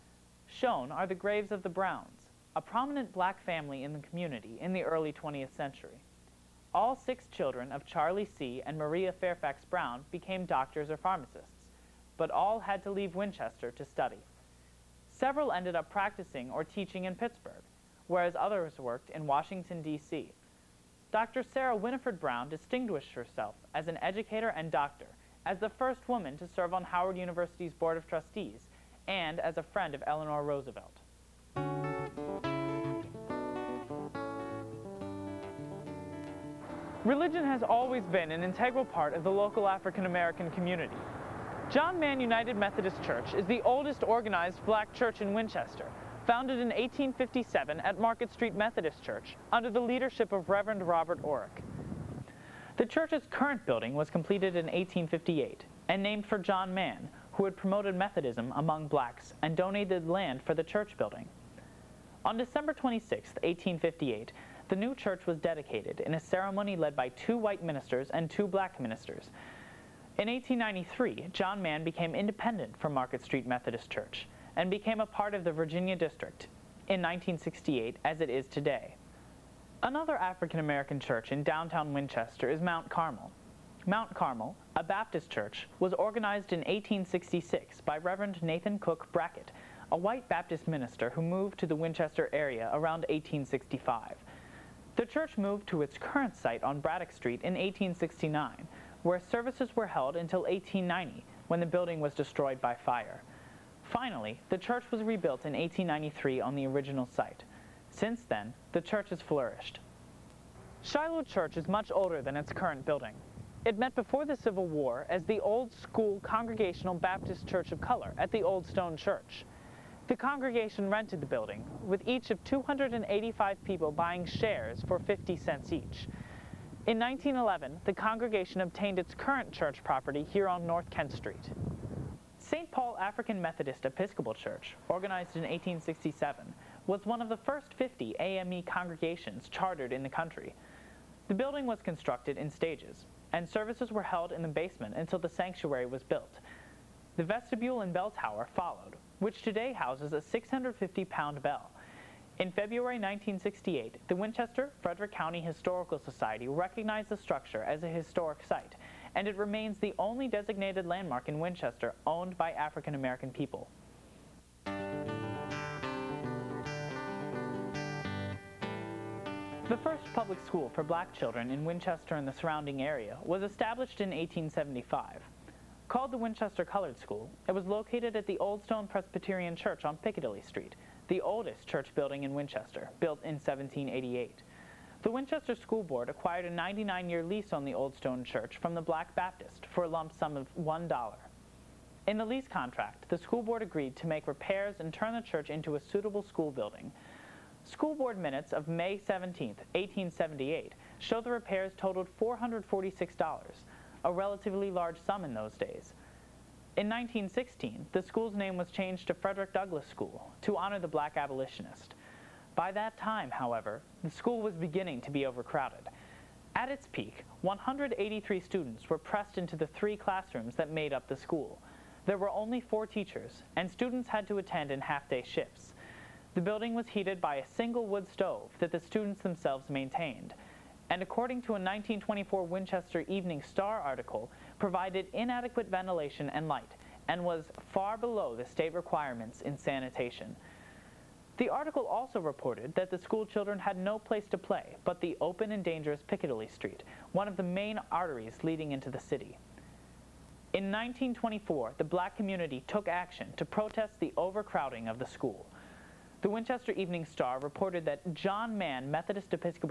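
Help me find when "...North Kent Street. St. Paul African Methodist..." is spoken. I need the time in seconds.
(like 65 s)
130 s.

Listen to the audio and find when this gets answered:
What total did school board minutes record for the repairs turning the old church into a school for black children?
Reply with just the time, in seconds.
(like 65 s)
202 s.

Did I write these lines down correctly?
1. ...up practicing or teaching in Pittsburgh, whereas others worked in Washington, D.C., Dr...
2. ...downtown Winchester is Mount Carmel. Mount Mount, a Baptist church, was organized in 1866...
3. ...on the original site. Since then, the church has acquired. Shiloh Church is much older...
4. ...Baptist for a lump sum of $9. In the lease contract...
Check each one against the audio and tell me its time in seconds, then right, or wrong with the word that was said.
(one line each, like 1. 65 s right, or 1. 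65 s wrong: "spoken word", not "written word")
1. 15 s right
2. 81 s wrong: "Carmel", not "Mount"
3. 106 s wrong: "flourished", not "acquired"
4. 189 s wrong: "1", not "9".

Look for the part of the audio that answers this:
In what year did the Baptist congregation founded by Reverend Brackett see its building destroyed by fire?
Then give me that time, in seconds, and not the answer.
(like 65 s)
100 s.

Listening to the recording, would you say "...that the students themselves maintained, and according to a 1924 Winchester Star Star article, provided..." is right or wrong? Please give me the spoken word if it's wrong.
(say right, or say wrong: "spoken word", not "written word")
wrong: "Evening", not "Star".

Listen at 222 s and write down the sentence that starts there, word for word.
There were only four teachers, and students had to attend in half-day shifts.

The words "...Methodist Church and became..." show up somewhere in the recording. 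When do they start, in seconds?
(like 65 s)
73 s.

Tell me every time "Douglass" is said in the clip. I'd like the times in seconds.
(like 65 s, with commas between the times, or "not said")
209 s.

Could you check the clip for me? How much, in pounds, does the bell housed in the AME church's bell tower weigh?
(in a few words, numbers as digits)
650.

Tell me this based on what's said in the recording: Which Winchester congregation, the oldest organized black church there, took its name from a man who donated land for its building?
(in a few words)
John Mann United Methodist Church.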